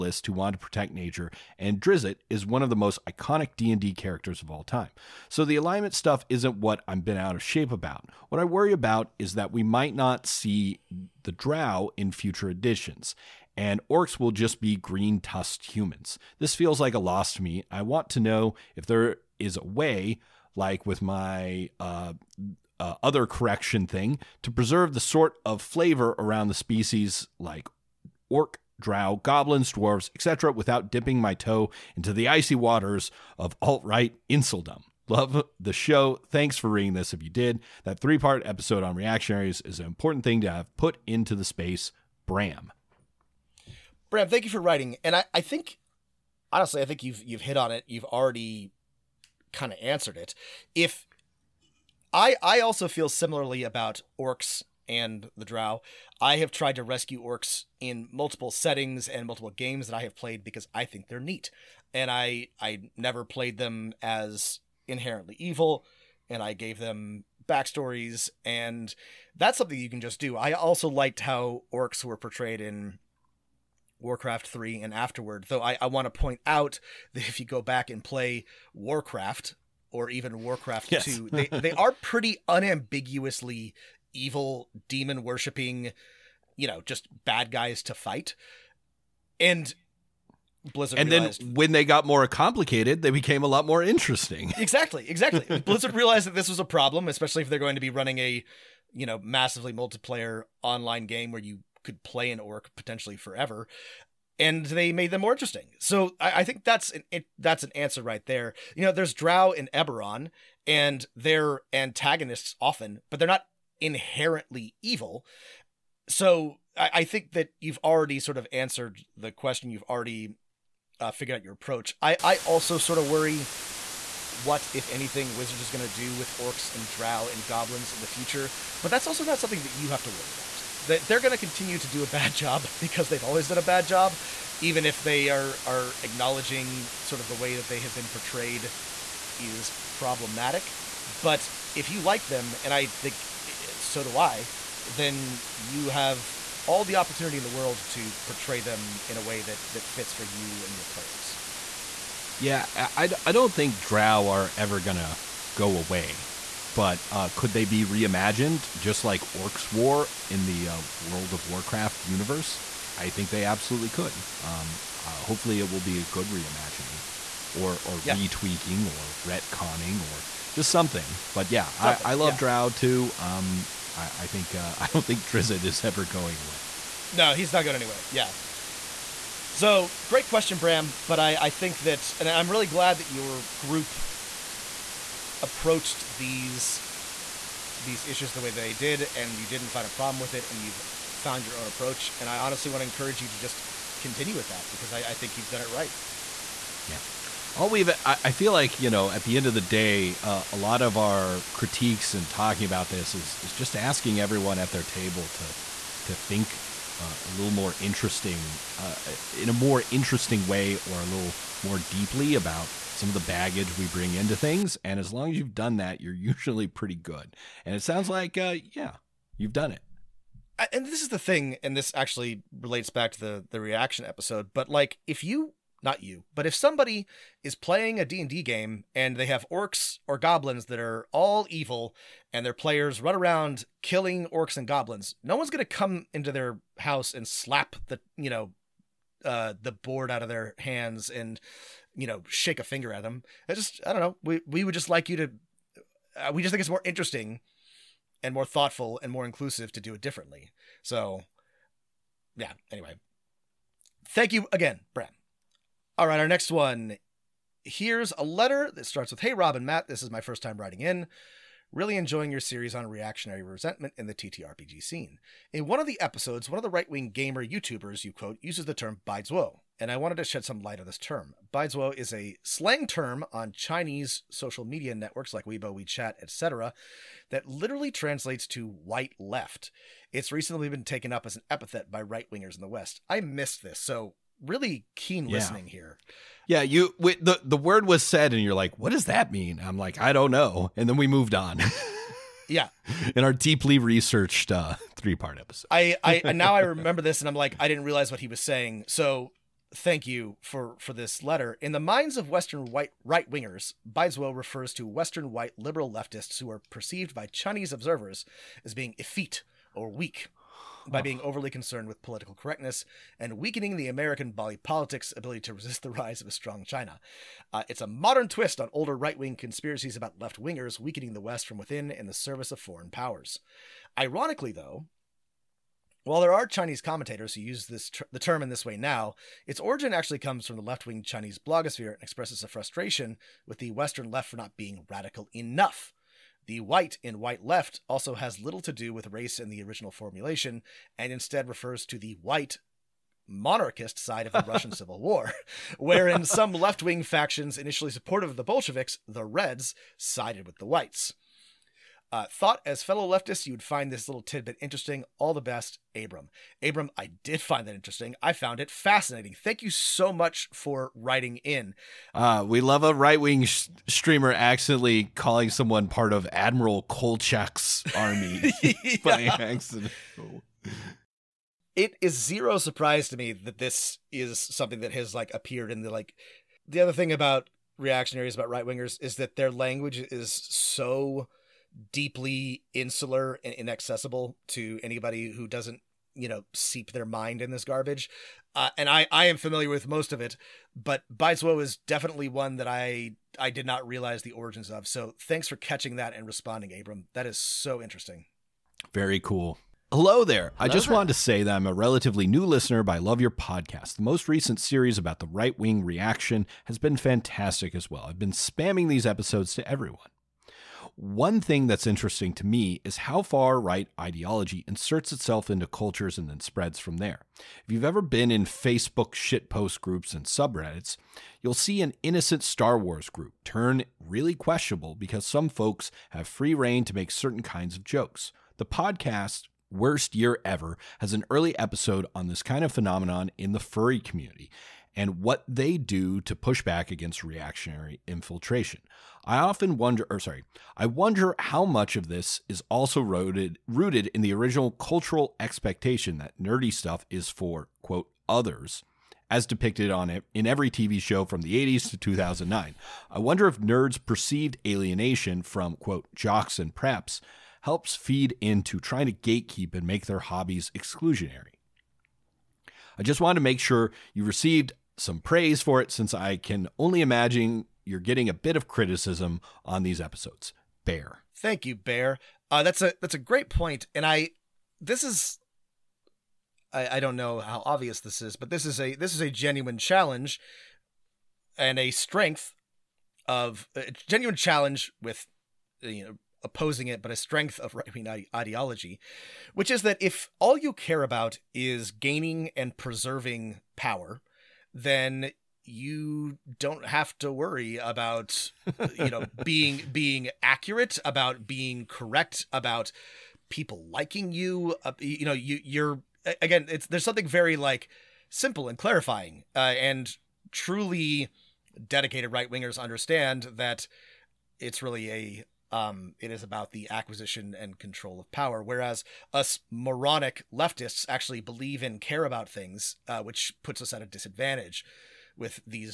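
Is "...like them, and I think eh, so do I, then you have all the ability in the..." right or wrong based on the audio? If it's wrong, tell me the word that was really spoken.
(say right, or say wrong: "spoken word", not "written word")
wrong: "opportunity", not "ability".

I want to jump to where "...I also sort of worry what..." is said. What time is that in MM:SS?
02:02.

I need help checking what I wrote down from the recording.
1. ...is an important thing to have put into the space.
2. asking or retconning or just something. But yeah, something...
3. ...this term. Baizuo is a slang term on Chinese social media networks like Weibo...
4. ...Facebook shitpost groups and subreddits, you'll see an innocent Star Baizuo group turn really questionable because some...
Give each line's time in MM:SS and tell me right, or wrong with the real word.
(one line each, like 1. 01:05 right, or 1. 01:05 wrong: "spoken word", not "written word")
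1. 00:39 right
2. 02:48 wrong: "retweaking", not "asking"
3. 04:30 right
4. 06:58 wrong: "Wars", not "Baizuo".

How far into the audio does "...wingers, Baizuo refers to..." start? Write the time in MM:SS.
05:03.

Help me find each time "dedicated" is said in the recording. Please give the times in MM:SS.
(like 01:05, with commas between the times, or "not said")
08:31.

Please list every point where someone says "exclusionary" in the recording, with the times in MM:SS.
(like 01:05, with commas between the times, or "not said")
07:40.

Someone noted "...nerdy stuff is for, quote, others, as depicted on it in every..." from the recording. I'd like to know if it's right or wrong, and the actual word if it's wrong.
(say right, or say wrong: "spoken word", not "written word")
right.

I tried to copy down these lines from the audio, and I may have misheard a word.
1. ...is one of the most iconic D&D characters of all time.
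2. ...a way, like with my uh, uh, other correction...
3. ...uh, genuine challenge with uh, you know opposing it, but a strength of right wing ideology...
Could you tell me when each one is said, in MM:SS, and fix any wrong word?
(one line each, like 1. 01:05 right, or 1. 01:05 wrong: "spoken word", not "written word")
1. 00:02 right
2. 00:19 right
3. 08:03 right.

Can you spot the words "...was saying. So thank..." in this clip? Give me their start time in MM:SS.
04:58.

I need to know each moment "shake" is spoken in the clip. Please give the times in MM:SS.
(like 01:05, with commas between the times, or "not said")
04:02.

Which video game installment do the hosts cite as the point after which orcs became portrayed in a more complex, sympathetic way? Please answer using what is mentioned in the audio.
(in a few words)
Warcraft 3.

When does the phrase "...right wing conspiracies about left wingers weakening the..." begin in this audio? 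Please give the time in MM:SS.
05:18.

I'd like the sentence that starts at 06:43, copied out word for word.
The most recent series about the right wing reaction has been fantastic as well.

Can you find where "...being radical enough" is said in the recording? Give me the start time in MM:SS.
05:34.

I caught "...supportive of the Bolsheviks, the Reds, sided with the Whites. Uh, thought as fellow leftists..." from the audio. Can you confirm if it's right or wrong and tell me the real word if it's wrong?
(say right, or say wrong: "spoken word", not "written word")
right.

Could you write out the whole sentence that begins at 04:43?
I missed this, so really keen yeah.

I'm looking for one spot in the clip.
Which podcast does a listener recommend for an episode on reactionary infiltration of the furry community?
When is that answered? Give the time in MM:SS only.
07:09.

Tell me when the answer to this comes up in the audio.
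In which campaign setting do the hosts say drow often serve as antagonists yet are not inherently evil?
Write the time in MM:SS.
01:49.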